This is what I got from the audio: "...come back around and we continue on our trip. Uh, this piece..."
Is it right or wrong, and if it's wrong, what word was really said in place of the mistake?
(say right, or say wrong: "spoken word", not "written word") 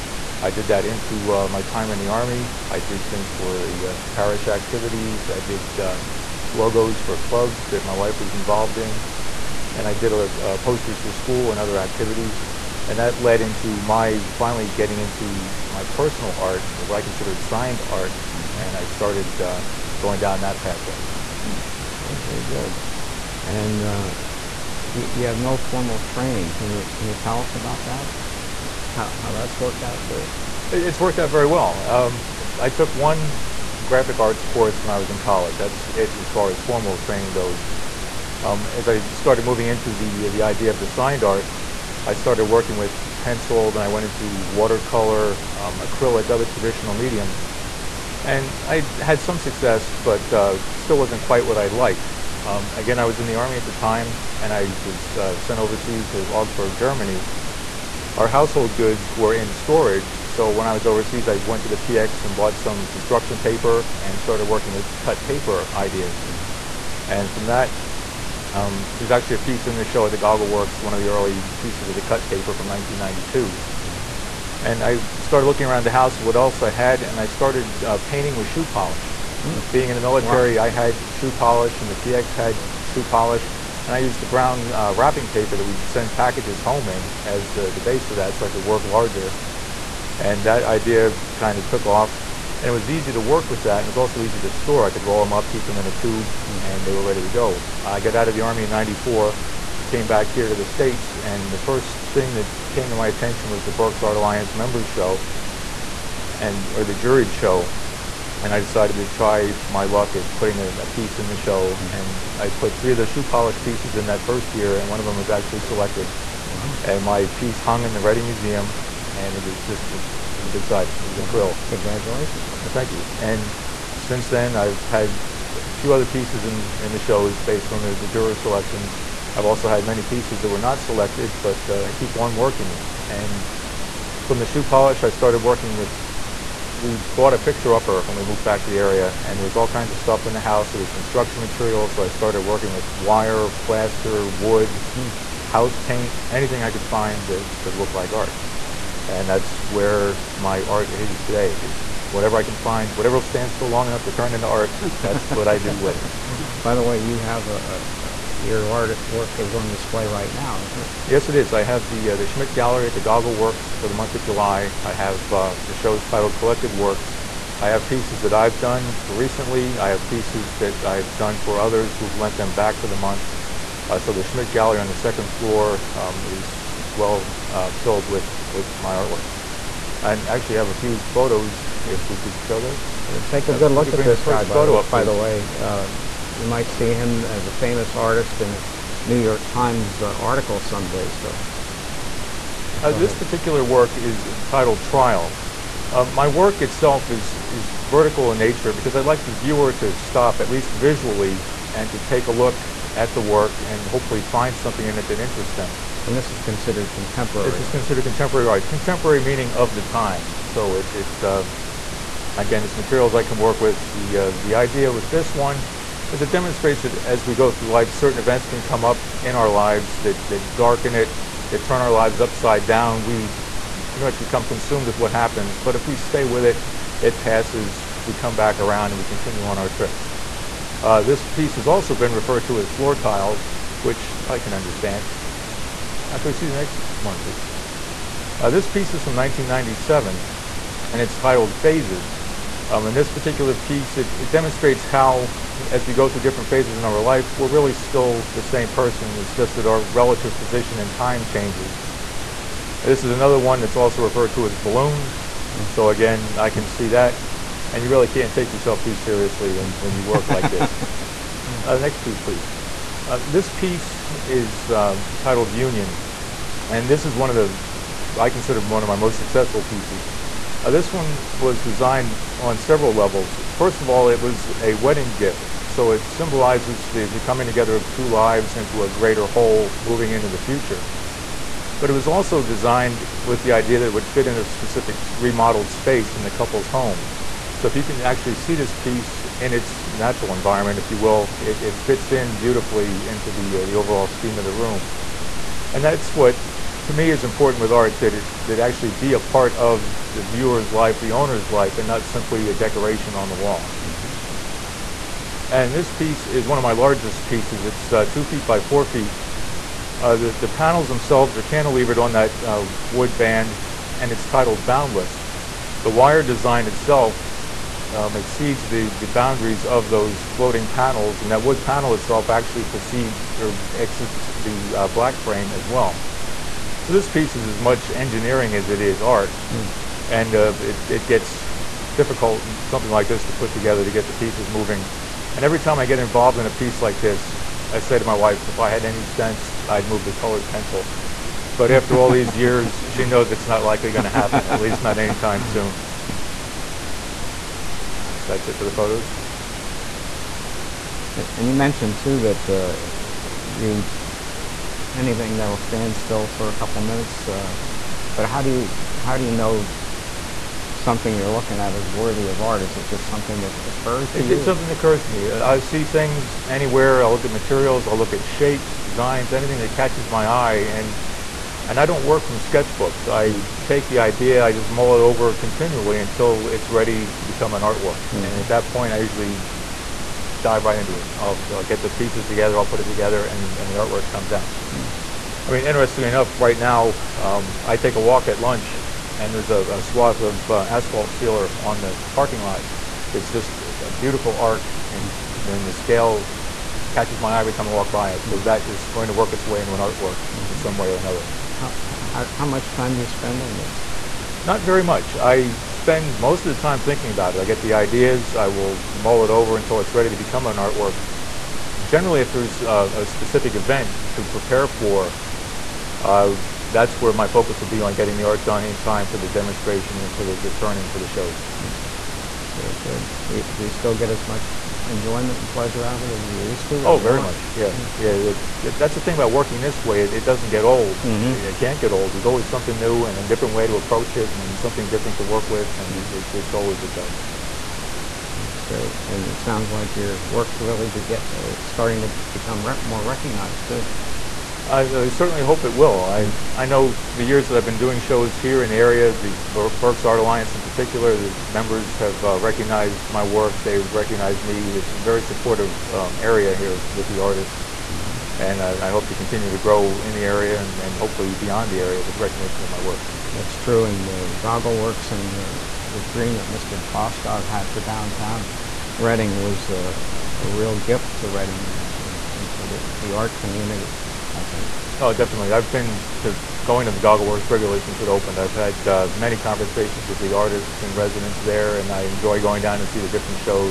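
right.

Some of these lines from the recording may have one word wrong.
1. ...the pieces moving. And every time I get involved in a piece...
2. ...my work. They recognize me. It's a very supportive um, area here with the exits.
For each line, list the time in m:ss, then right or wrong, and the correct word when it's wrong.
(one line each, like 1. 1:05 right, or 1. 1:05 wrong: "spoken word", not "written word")
1. 5:34 right
2. 7:33 wrong: "artists", not "exits".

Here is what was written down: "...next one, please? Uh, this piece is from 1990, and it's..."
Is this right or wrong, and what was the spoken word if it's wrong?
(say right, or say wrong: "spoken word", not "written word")
wrong: "1997", not "1990".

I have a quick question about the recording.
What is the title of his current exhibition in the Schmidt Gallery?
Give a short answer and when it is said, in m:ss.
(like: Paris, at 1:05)
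Collected Works, at 2:46.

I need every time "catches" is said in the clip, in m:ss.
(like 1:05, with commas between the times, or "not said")
6:09, 6:36.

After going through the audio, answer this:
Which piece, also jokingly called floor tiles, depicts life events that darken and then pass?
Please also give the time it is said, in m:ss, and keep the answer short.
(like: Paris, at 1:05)
Trial, at 3:14.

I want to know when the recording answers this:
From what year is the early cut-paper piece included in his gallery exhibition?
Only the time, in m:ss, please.
1:12.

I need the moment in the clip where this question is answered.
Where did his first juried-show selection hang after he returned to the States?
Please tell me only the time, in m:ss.
1:57.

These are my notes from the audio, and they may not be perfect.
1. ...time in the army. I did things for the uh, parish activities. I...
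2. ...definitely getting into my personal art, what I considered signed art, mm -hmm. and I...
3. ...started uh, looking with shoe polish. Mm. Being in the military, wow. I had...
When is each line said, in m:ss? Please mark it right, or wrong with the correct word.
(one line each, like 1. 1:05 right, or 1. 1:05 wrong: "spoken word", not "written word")
1. 0:01 right
2. 0:14 wrong: "finally", not "definitely"
3. 1:17 wrong: "painting", not "looking".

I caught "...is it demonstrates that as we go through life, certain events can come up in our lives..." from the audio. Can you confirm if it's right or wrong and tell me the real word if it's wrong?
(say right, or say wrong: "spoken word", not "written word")
right.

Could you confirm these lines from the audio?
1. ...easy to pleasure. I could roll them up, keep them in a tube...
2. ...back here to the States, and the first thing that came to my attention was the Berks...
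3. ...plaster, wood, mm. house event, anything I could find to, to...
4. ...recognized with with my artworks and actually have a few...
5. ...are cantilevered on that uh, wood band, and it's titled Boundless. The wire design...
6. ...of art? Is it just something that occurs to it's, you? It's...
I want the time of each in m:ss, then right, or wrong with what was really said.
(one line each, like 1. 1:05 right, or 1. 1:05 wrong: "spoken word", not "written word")
1. 1:34 wrong: "store", not "pleasure"
2. 1:40 right
3. 2:23 wrong: "paint", not "event"
4. 2:57 wrong: "filled", not "recognized"
5. 5:11 right
6. 6:02 right.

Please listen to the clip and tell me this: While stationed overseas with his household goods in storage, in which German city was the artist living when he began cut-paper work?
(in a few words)
Augsburg.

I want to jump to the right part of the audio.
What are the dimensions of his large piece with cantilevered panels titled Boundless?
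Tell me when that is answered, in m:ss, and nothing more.
5:08.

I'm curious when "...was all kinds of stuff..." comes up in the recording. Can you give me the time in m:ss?
2:19.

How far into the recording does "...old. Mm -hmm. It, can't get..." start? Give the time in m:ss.
7:10.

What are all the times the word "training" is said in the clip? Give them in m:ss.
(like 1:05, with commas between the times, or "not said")
0:26, 0:36.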